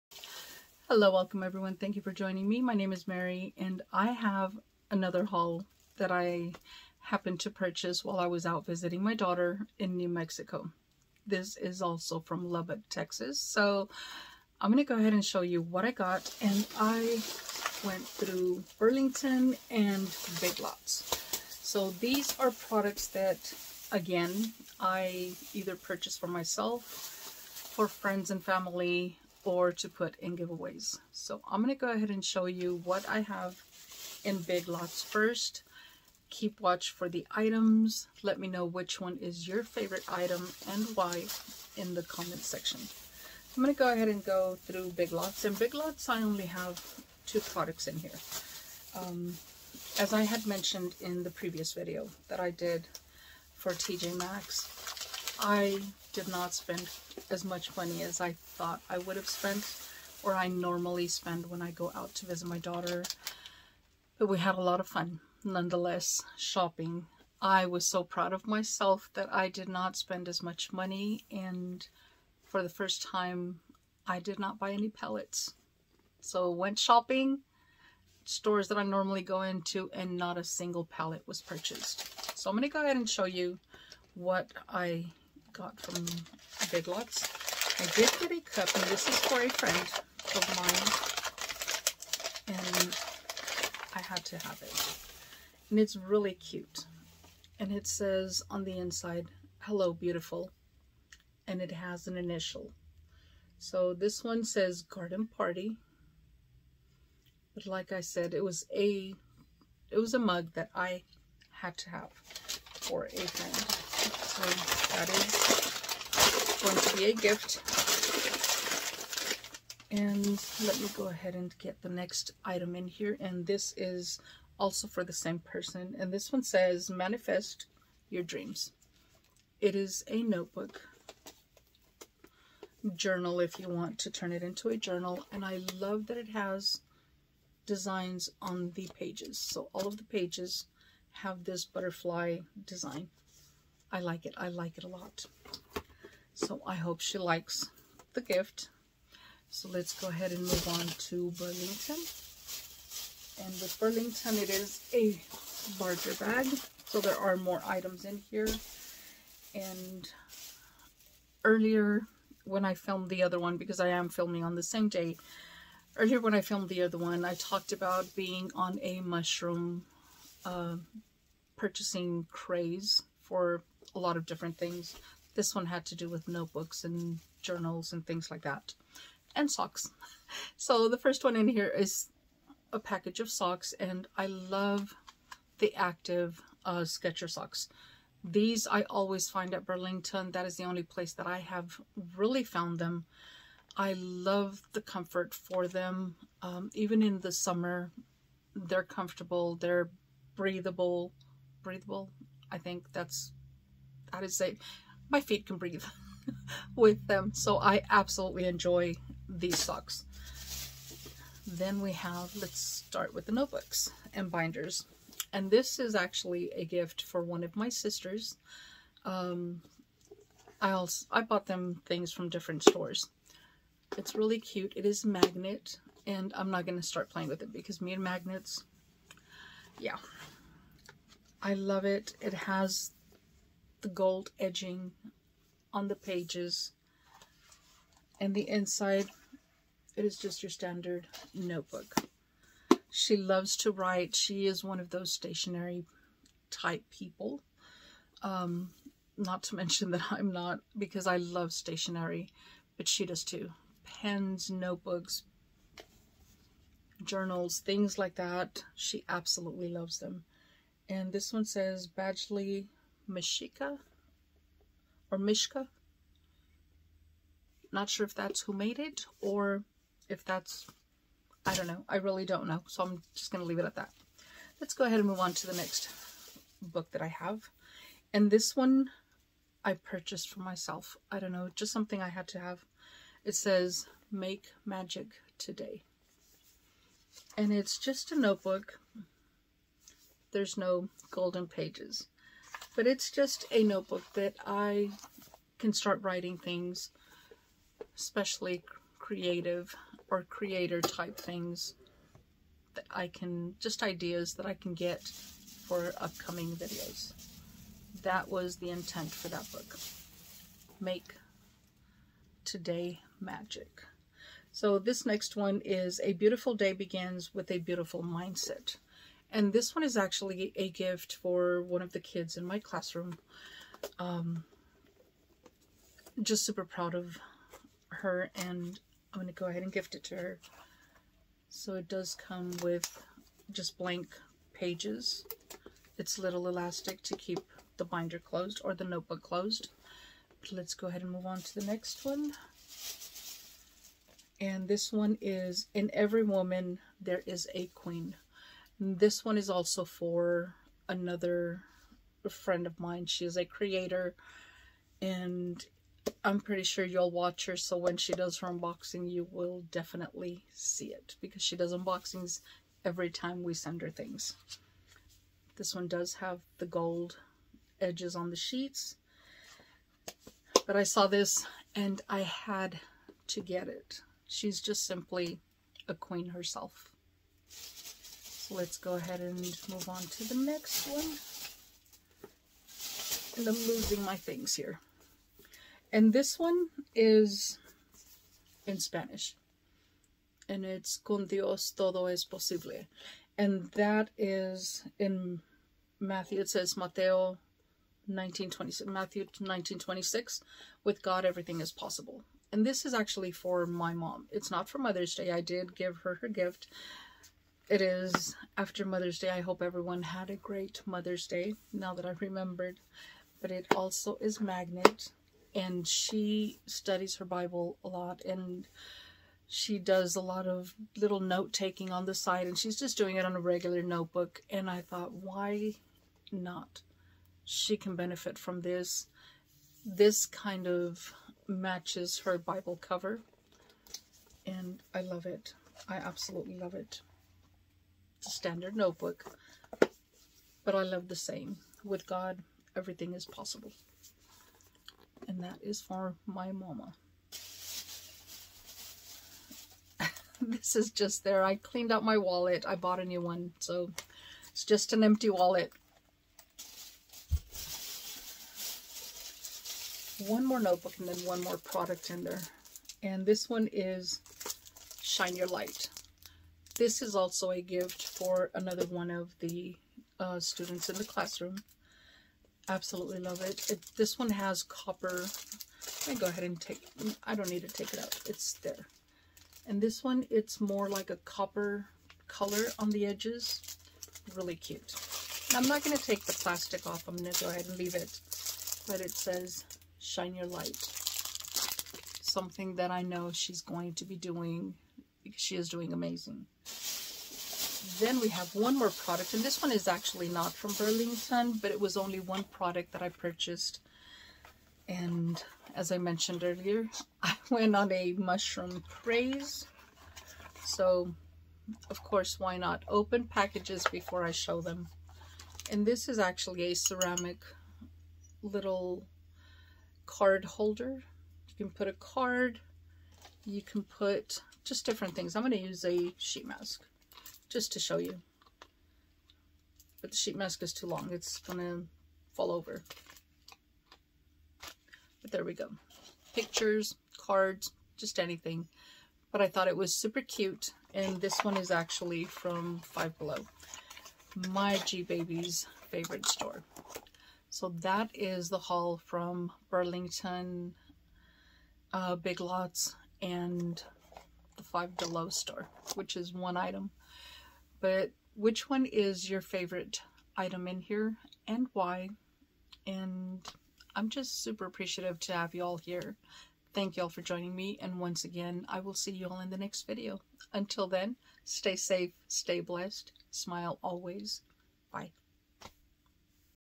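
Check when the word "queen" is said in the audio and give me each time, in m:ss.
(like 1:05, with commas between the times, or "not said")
5:47, 6:15.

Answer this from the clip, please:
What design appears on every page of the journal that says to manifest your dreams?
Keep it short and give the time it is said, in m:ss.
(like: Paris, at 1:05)
Butterfly, at 2:21.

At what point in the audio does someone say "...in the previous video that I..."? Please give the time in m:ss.
0:51.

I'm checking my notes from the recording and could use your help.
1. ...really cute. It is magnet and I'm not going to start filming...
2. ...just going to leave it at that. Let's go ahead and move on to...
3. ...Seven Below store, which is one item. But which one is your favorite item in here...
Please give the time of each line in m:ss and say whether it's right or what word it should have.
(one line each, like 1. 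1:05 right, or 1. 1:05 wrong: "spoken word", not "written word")
1. 3:44 wrong: "playing", not "filming"
2. 4:33 right
3. 9:14 wrong: "Five", not "Seven".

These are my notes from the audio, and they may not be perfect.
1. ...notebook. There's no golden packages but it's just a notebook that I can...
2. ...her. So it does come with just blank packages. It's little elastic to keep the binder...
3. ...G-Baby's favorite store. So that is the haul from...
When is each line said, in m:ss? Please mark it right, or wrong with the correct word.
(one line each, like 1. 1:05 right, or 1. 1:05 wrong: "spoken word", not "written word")
1. 4:48 wrong: "pages", not "packages"
2. 5:30 wrong: "pages", not "packages"
3. 9:04 right.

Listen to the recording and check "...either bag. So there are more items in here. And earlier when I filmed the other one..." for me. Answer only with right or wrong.
wrong.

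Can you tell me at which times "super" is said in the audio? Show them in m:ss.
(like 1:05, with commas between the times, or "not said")
5:26, 8:59, 9:24.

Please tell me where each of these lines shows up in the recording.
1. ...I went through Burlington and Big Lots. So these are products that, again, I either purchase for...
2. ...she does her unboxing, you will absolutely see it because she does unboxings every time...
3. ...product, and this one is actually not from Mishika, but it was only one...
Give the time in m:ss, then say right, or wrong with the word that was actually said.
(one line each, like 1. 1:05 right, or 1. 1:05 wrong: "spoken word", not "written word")
1. 0:16 right
2. 5:57 wrong: "definitely", not "absolutely"
3. 8:18 wrong: "Burlington", not "Mishika".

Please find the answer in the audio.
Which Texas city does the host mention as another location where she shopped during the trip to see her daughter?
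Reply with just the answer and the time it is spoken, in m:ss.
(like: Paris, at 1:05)
Lubbock, at 0:12.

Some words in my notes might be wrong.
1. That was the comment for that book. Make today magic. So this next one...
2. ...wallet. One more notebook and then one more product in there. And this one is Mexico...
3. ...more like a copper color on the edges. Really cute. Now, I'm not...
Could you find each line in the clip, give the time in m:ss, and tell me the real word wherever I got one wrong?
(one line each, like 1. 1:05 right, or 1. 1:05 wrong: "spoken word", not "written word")
1. 5:08 wrong: "intent", not "comment"
2. 7:35 wrong: "Shine", not "Mexico"
3. 8:00 right.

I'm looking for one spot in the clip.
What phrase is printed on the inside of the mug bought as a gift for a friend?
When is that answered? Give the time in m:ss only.
1:39.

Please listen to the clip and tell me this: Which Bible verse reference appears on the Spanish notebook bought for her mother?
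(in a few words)
Matthew 19:26.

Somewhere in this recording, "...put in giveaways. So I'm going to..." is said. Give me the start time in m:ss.
0:29.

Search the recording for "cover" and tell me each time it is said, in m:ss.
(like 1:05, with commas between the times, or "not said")
7:12.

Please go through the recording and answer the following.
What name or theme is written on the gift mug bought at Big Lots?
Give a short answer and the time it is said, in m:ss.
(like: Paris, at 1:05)
Garden Party, at 1:44.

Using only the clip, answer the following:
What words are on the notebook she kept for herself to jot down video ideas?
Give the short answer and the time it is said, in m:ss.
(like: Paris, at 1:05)
Make magic today, at 4:44.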